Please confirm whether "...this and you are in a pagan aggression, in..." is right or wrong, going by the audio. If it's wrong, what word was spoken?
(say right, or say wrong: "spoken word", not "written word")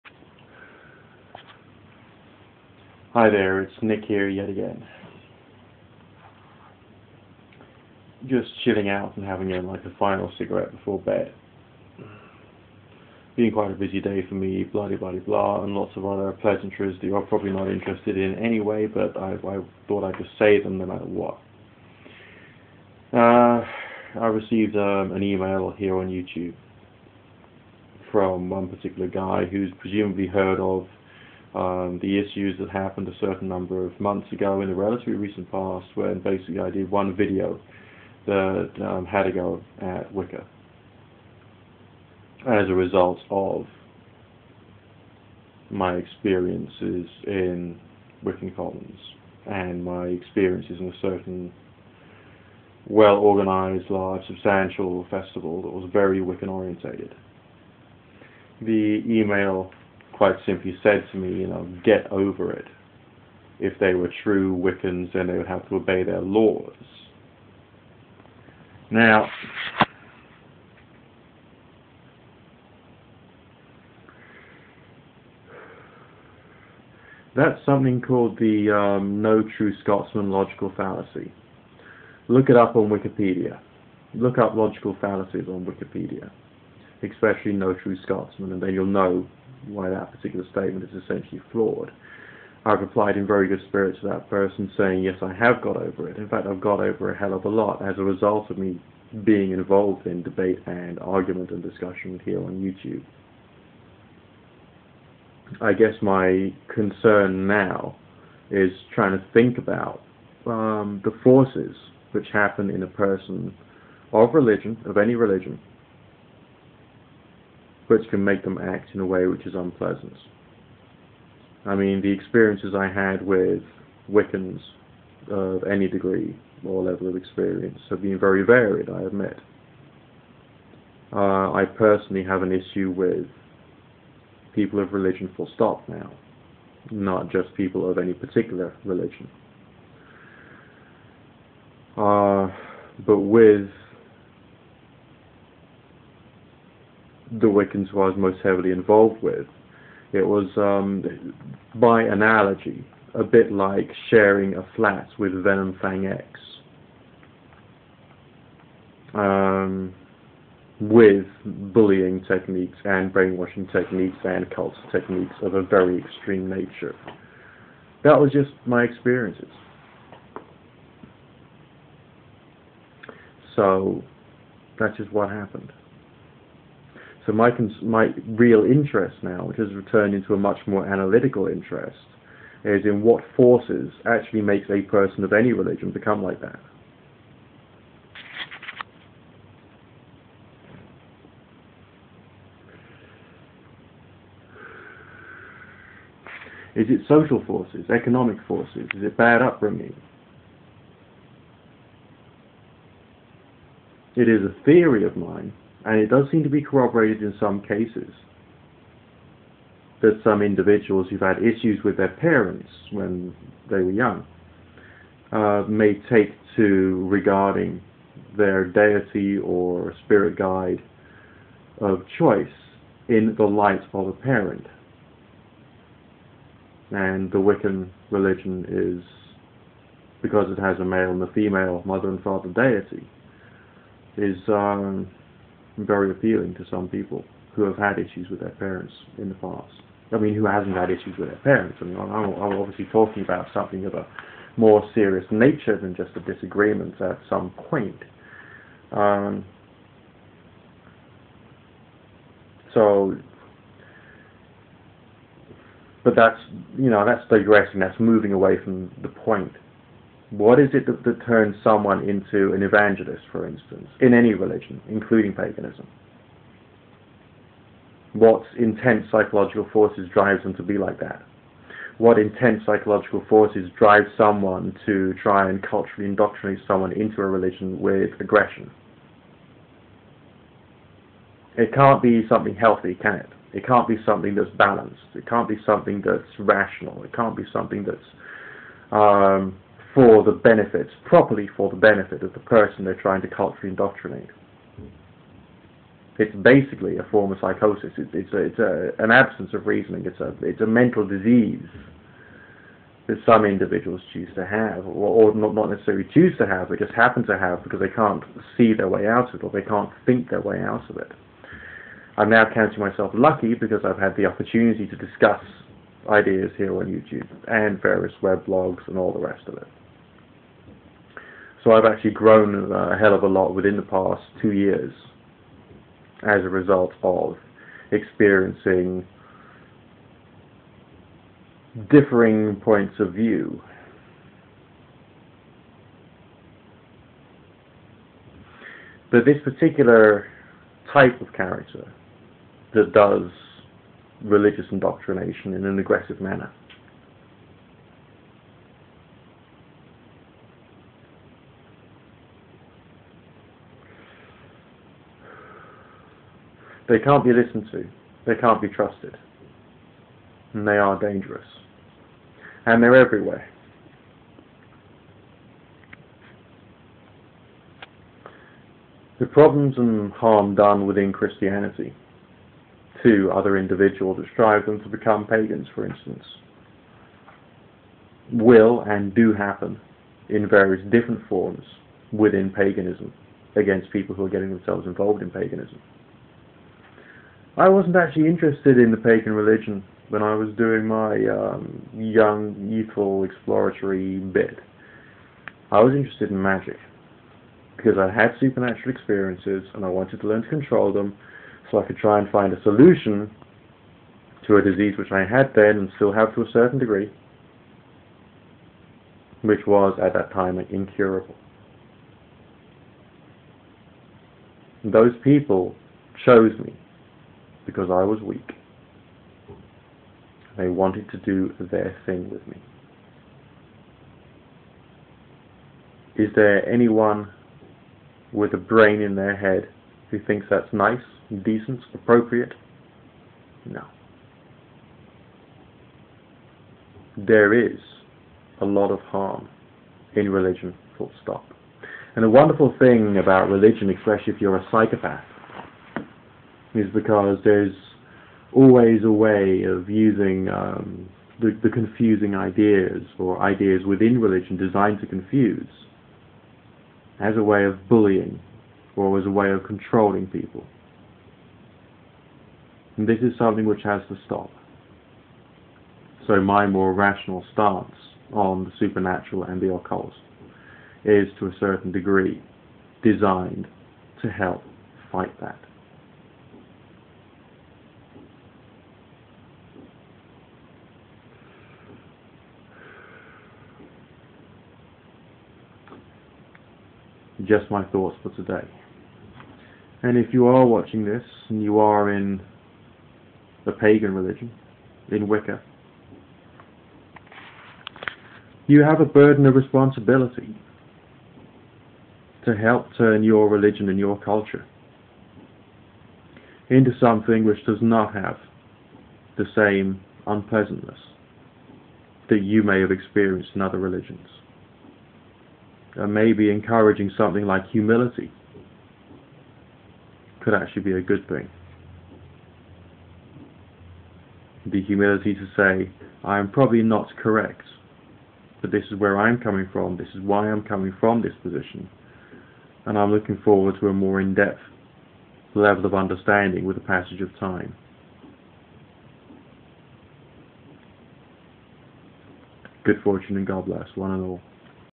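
wrong: "religion", not "aggression".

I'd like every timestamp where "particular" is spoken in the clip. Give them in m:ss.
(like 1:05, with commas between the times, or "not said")
0:28, 1:30, 2:18, 5:39.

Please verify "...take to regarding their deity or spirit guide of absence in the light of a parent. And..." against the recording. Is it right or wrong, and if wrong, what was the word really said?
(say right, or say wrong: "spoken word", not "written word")
wrong: "choice", not "absence".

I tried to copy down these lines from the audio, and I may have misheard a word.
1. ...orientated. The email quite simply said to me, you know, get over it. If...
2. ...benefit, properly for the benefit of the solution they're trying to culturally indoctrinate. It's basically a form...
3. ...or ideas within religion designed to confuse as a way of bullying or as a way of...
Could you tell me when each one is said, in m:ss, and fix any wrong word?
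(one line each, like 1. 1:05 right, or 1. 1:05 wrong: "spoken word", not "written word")
1. 0:56 right
2. 4:50 wrong: "person", not "solution"
3. 7:33 right.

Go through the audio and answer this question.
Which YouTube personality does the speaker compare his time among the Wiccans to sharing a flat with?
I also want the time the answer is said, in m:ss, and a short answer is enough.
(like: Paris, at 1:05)
VenomFangX, at 2:35.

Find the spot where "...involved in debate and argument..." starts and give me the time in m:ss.
1:39.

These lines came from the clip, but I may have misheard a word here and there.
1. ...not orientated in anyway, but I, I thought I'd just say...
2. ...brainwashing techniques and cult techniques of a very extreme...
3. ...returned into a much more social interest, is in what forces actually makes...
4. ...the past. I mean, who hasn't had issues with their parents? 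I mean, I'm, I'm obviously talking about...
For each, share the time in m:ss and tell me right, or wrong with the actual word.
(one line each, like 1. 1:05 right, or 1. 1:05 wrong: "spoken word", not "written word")
1. 0:17 wrong: "interested", not "orientated"
2. 2:43 right
3. 2:59 wrong: "analytical", not "social"
4. 3:59 right.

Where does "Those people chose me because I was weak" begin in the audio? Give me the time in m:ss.
6:54.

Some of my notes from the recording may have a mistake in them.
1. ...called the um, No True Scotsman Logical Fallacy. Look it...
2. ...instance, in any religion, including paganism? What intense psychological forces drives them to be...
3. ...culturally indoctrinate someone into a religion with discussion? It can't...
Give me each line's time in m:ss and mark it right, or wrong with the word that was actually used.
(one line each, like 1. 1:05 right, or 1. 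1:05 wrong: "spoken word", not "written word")
1. 1:17 right
2. 4:23 right
3. 4:35 wrong: "aggression", not "discussion".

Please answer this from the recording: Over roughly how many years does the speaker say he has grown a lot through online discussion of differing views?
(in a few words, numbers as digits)
2 years.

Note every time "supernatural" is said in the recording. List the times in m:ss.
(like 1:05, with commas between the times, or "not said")
6:38, 7:48.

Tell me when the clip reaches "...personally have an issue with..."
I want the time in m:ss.
2:11.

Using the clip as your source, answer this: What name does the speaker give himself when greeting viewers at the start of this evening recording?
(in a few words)
Nick.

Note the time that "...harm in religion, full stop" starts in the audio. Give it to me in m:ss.
7:18.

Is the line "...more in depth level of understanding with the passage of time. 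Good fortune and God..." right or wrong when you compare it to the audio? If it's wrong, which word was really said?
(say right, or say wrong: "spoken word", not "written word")
right.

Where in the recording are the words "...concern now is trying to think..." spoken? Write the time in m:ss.
1:46.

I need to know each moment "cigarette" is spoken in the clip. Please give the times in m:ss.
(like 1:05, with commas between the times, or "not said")
0:10.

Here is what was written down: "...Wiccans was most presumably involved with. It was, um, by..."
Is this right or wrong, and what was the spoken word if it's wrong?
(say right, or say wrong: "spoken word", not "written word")
wrong: "heavily", not "presumably".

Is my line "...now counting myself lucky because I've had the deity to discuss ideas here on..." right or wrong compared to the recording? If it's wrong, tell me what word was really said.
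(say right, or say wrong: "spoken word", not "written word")
wrong: "opportunity", not "deity".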